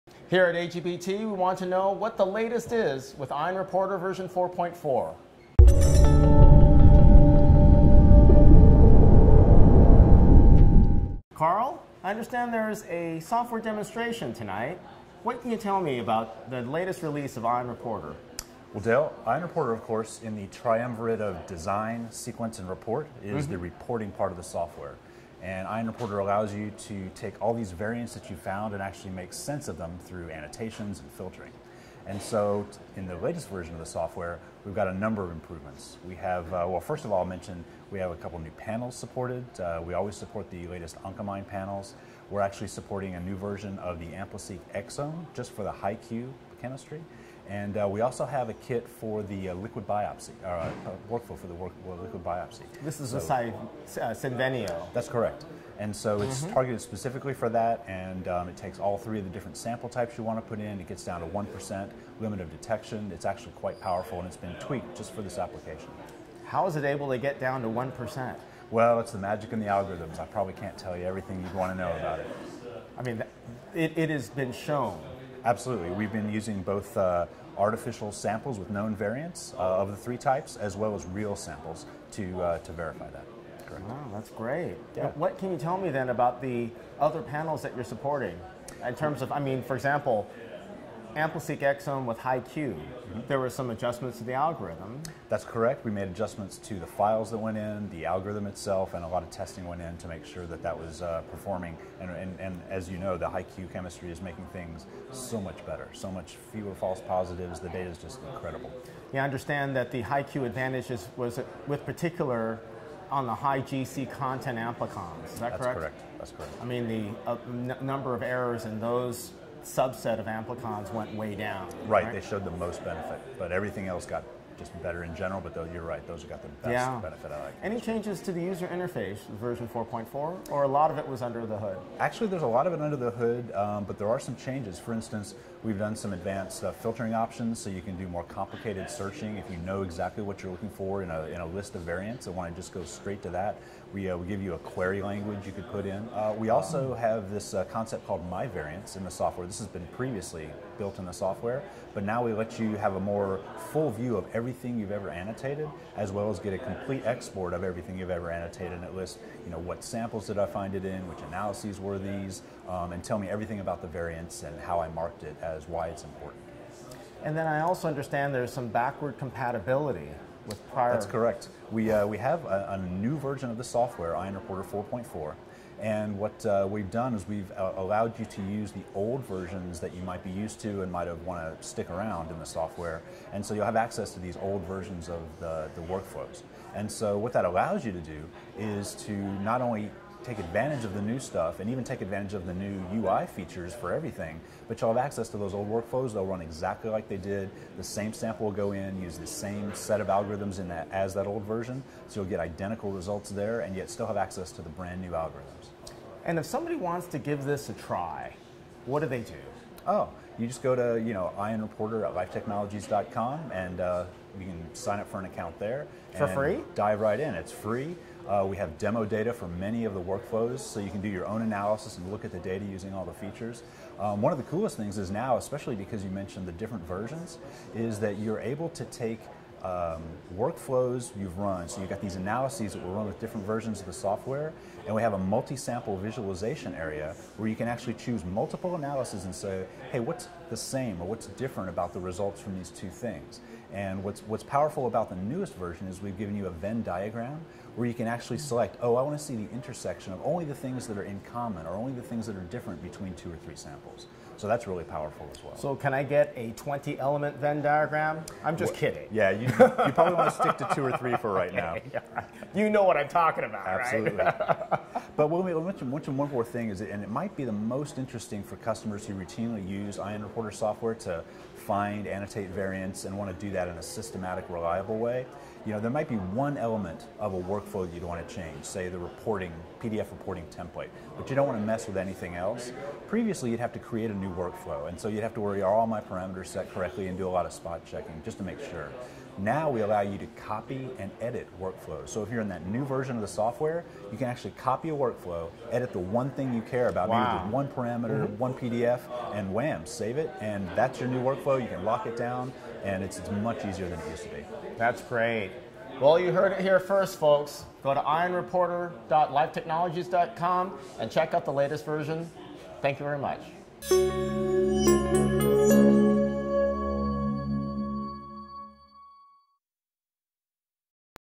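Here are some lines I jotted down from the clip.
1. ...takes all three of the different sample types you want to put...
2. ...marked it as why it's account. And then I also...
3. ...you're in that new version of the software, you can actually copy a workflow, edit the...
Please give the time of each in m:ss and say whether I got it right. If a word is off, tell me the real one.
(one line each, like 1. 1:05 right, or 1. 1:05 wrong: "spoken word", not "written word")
1. 0:58 right
2. 2:44 wrong: "important", not "account"
3. 4:52 right.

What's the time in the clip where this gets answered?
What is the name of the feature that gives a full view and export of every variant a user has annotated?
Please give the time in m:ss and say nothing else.
2:28.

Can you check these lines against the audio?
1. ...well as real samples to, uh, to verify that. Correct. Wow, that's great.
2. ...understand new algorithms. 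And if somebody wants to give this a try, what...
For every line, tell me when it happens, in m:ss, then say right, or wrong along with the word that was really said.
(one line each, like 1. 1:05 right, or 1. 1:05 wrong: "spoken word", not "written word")
1. 1:20 right
2. 3:24 wrong: "brand", not "understand".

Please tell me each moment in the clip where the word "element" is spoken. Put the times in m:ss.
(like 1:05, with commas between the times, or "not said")
4:16, 4:36.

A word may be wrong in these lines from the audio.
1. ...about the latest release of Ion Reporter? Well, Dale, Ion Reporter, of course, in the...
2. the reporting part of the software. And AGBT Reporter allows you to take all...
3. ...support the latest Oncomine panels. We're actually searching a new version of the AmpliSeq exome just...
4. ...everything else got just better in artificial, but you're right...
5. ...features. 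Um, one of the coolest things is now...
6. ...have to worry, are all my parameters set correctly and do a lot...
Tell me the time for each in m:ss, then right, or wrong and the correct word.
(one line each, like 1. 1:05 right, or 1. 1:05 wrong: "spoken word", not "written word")
1. 0:15 right
2. 0:23 wrong: "Ion", not "AGBT"
3. 0:40 wrong: "supporting", not "searching"
4. 2:03 wrong: "general", not "artificial"
5. 3:43 right
6. 4:45 right.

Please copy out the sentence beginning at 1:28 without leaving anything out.
In terms of, I mean, for example, AmpliSeq exome with HiQ, mm -hmm.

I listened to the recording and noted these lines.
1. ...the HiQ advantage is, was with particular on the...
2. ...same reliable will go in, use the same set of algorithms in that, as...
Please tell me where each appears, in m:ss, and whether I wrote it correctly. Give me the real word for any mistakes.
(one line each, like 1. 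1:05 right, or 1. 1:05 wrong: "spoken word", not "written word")
1. 1:49 right
2. 3:17 wrong: "sample", not "reliable".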